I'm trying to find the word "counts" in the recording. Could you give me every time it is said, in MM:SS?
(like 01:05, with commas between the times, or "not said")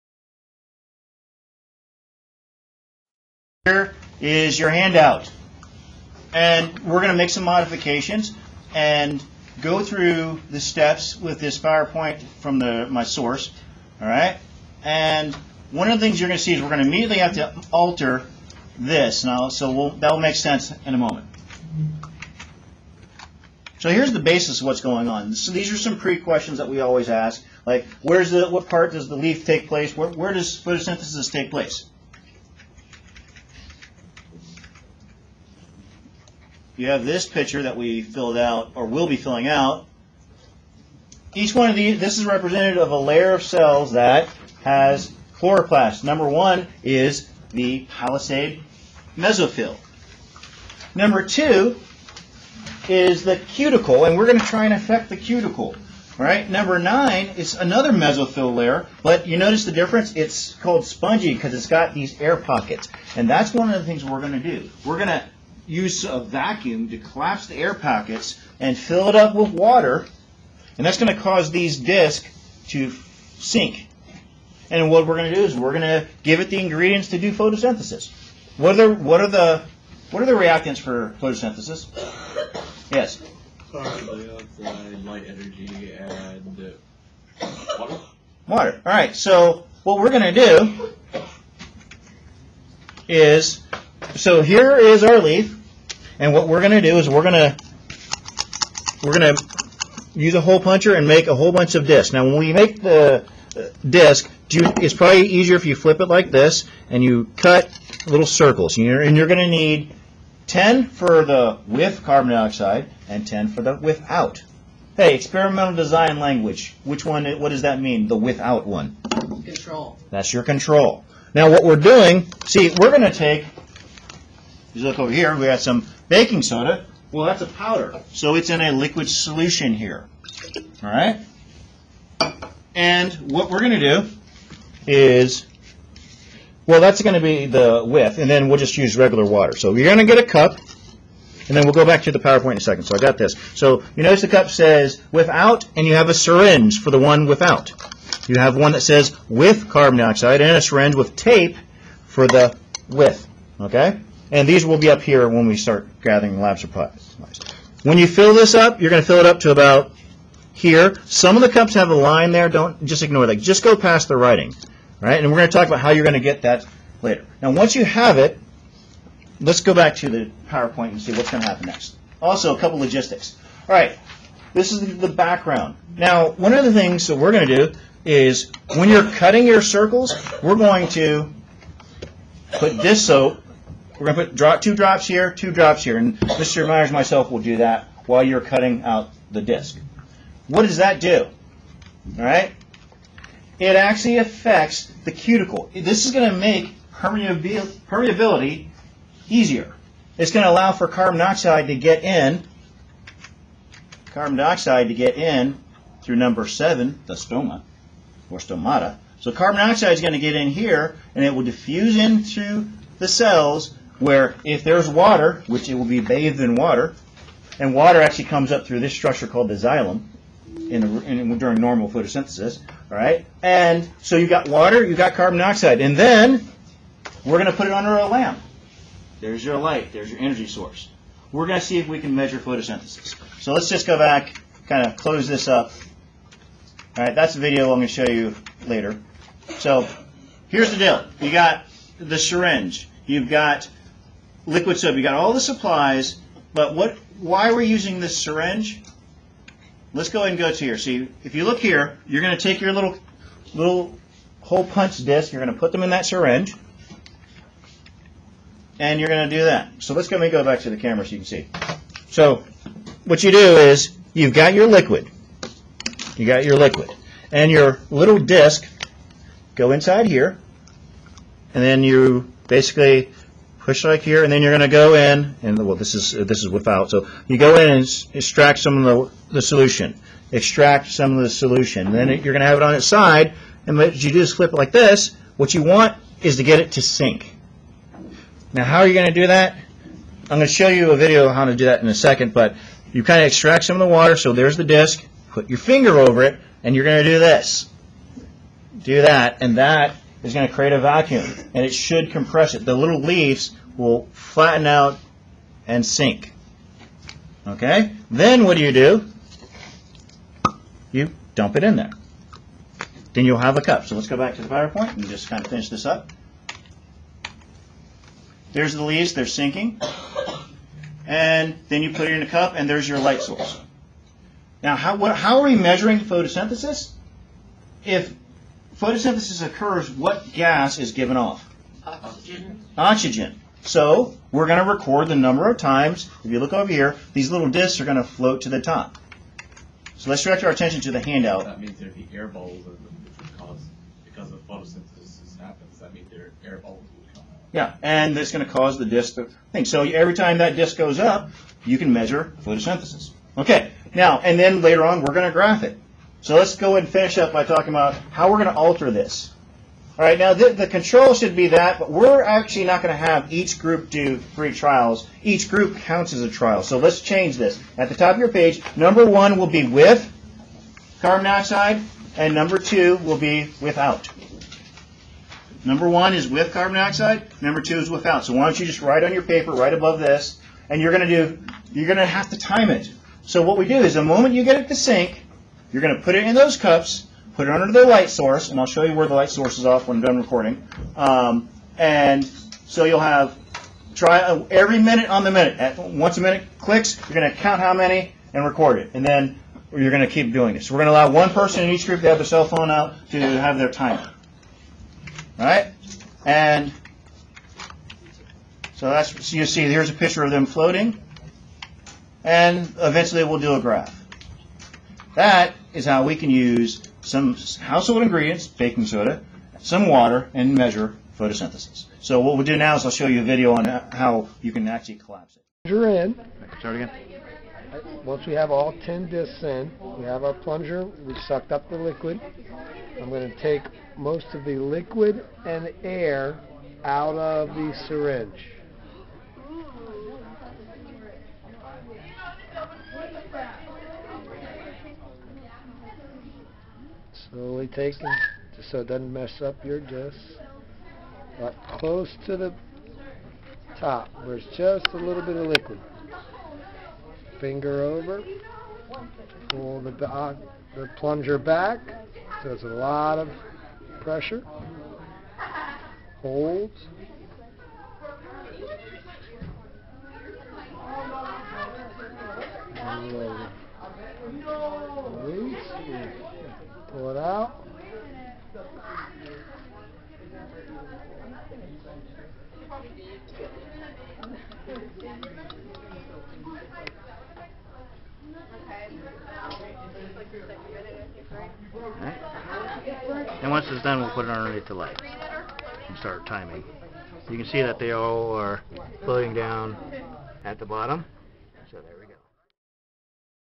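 06:05, 06:37.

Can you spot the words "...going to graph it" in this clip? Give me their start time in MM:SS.
05:55.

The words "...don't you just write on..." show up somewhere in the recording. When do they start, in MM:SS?
06:18.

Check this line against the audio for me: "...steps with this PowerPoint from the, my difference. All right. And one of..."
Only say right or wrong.
wrong.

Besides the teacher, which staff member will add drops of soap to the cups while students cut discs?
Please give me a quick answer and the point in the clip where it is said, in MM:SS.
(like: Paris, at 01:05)
Mr. Myers, at 03:06.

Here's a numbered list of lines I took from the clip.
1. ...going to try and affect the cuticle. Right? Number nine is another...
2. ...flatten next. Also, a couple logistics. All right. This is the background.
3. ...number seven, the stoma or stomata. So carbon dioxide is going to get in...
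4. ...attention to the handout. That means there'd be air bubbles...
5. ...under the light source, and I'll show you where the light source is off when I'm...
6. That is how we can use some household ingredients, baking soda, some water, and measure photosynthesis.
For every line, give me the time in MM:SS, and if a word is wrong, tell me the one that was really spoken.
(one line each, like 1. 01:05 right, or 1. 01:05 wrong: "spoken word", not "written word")
1. 00:54 right
2. 02:51 wrong: "happen", not "flatten"
3. 03:26 right
4. 05:40 right
5. 06:27 right
6. 06:55 right.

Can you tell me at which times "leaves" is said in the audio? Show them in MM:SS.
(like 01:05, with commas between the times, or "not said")
05:02, 05:18.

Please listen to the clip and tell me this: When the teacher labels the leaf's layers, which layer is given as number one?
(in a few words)
palisade mesophyll.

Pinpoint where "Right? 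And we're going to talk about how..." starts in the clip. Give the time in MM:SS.
02:45.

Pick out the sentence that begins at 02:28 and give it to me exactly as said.
You have one that says with carbon dioxide and a syringe with tape for the with.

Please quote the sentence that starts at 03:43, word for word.
And so you've got water, you've got carbon dioxide, and then we're going to put it under a lamp.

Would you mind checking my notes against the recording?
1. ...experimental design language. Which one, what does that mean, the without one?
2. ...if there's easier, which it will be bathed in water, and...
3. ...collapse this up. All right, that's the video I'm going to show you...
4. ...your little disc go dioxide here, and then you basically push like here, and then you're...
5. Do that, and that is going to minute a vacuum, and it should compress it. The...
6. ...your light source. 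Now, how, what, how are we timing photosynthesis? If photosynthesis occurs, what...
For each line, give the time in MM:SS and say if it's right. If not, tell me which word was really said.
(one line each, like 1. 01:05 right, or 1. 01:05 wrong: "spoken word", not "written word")
1. 01:55 right
2. 03:34 wrong: "water", not "easier"
3. 03:54 wrong: "close", not "collapse"
4. 04:27 wrong: "inside", not "dioxide"
5. 04:58 wrong: "create", not "minute"
6. 05:22 wrong: "measuring", not "timing".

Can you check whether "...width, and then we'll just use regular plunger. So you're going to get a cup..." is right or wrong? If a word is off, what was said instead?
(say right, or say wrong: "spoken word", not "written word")
wrong: "water", not "plunger".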